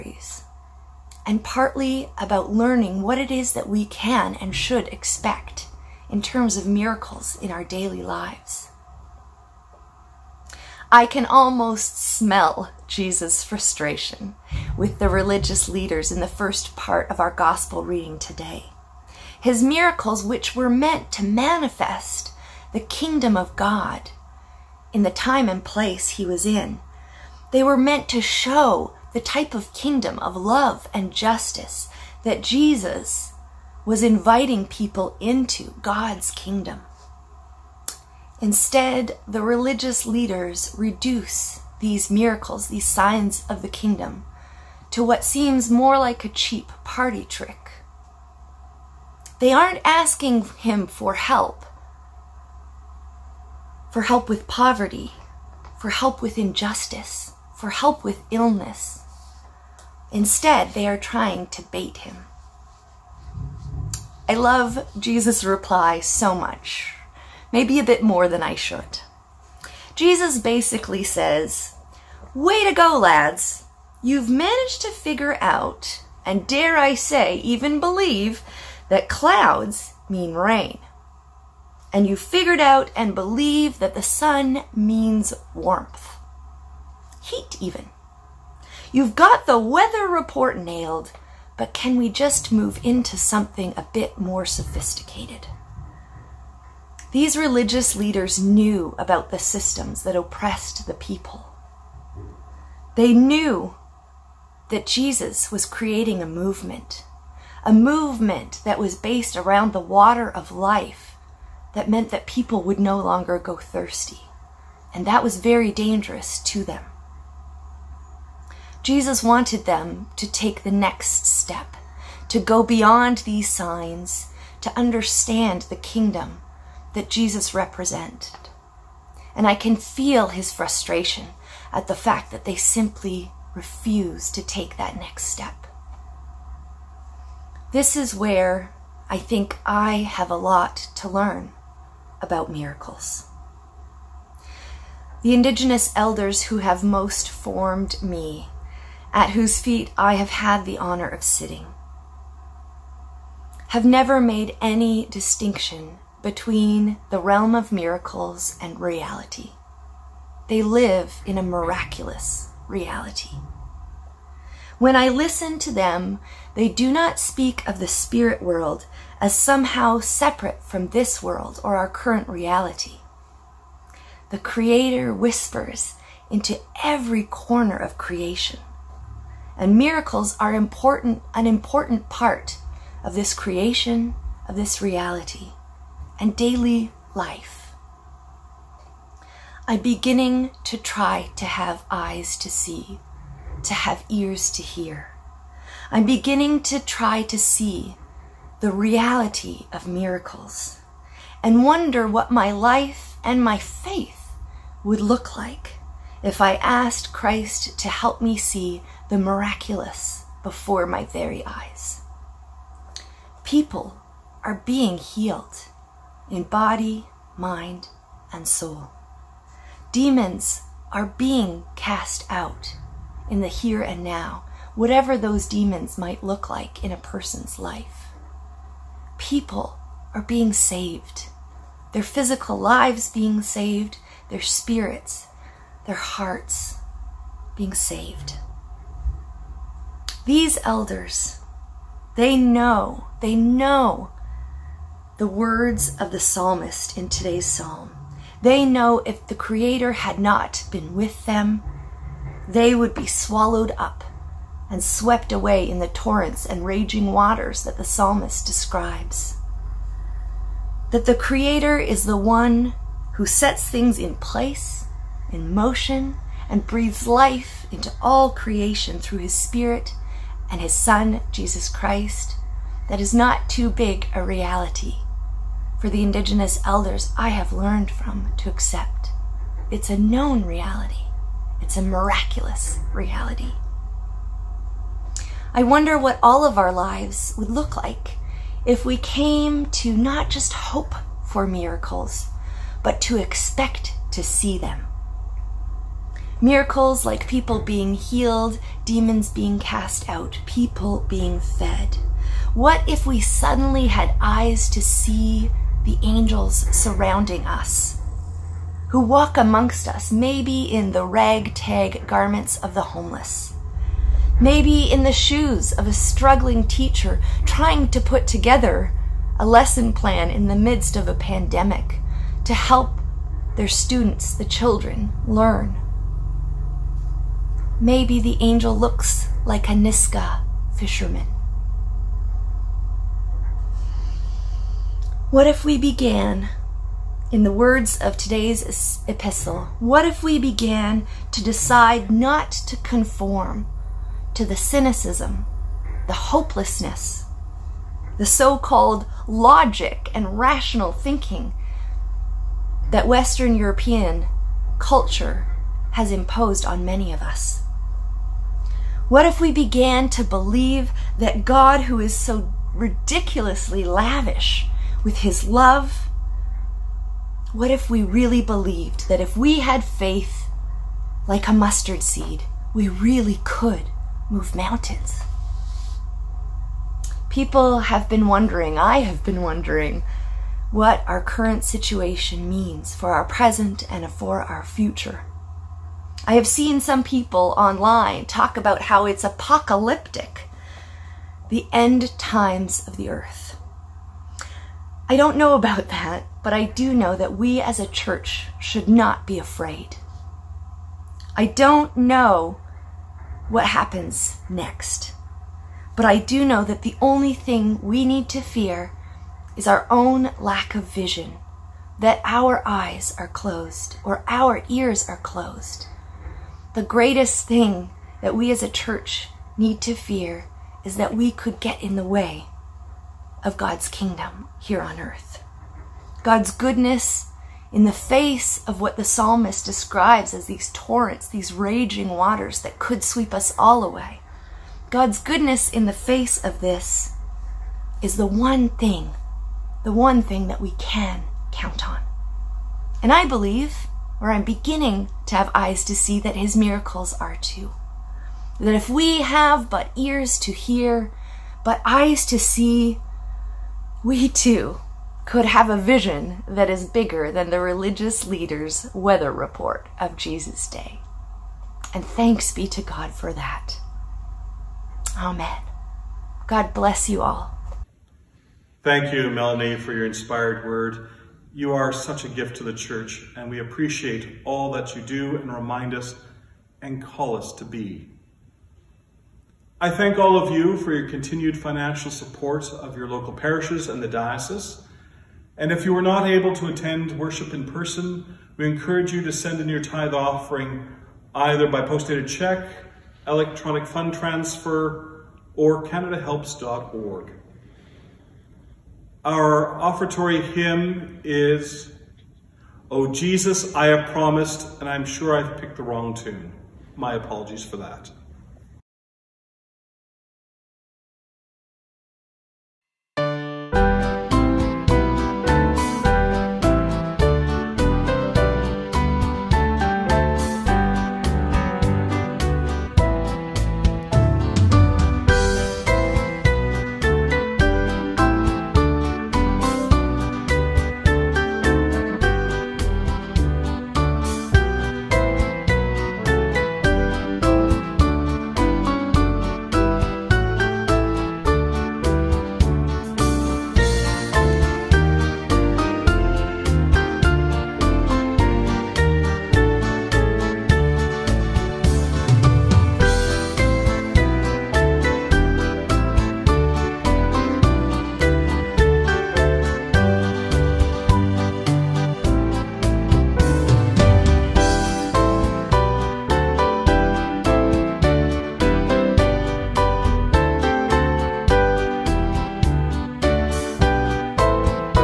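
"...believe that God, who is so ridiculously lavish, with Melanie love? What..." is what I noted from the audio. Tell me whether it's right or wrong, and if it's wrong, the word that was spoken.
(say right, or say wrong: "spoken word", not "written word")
wrong: "His", not "Melanie".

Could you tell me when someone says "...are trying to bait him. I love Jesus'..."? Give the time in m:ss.
1:00.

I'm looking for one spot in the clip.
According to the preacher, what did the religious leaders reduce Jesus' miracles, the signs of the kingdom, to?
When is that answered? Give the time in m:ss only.
0:46.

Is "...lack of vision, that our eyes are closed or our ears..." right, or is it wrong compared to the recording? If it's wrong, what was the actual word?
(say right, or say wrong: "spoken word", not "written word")
right.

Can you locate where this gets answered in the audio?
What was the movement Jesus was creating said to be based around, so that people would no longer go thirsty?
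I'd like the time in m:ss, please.
1:49.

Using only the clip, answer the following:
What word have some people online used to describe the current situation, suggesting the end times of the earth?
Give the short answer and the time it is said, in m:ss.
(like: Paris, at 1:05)
apocalyptic, at 6:29.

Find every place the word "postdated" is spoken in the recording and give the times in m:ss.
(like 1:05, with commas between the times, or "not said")
8:11.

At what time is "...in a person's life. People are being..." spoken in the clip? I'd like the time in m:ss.
3:46.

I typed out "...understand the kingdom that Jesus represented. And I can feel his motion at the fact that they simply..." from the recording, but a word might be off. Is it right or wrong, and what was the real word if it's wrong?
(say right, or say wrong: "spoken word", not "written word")
wrong: "frustration", not "motion".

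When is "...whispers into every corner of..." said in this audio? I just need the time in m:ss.
2:55.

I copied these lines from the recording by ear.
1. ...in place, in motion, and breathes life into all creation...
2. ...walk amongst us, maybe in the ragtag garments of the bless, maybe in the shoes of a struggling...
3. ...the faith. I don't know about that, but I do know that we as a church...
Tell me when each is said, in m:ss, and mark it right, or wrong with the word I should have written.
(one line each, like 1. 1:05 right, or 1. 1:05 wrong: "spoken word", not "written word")
1. 4:23 right
2. 5:08 wrong: "homeless", not "bless"
3. 6:32 wrong: "earth", not "faith".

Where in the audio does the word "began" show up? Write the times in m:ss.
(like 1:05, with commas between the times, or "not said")
5:35, 5:40, 5:59.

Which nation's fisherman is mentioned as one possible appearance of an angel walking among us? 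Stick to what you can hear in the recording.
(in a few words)
Nisga'a.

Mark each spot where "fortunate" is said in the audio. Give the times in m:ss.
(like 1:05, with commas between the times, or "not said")
not said.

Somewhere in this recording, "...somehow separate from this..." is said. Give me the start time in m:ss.
2:49.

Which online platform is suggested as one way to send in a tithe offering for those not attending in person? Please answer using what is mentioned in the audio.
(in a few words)
CanadaHelps.org.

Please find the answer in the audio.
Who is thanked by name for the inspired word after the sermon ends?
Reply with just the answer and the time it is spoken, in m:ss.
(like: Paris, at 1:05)
Melanie, at 7:49.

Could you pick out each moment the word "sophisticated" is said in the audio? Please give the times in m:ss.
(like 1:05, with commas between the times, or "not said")
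1:34.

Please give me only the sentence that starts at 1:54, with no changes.
And that was very dangerous to them.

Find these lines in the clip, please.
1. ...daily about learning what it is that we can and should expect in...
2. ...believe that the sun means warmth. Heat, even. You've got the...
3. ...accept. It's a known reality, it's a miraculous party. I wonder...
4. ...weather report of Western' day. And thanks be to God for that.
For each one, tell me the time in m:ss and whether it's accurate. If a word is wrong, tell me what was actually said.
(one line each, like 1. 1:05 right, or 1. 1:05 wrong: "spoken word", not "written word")
1. 0:01 wrong: "partly", not "daily"
2. 1:23 right
3. 4:38 wrong: "reality", not "party"
4. 7:38 wrong: "Jesus", not "Western".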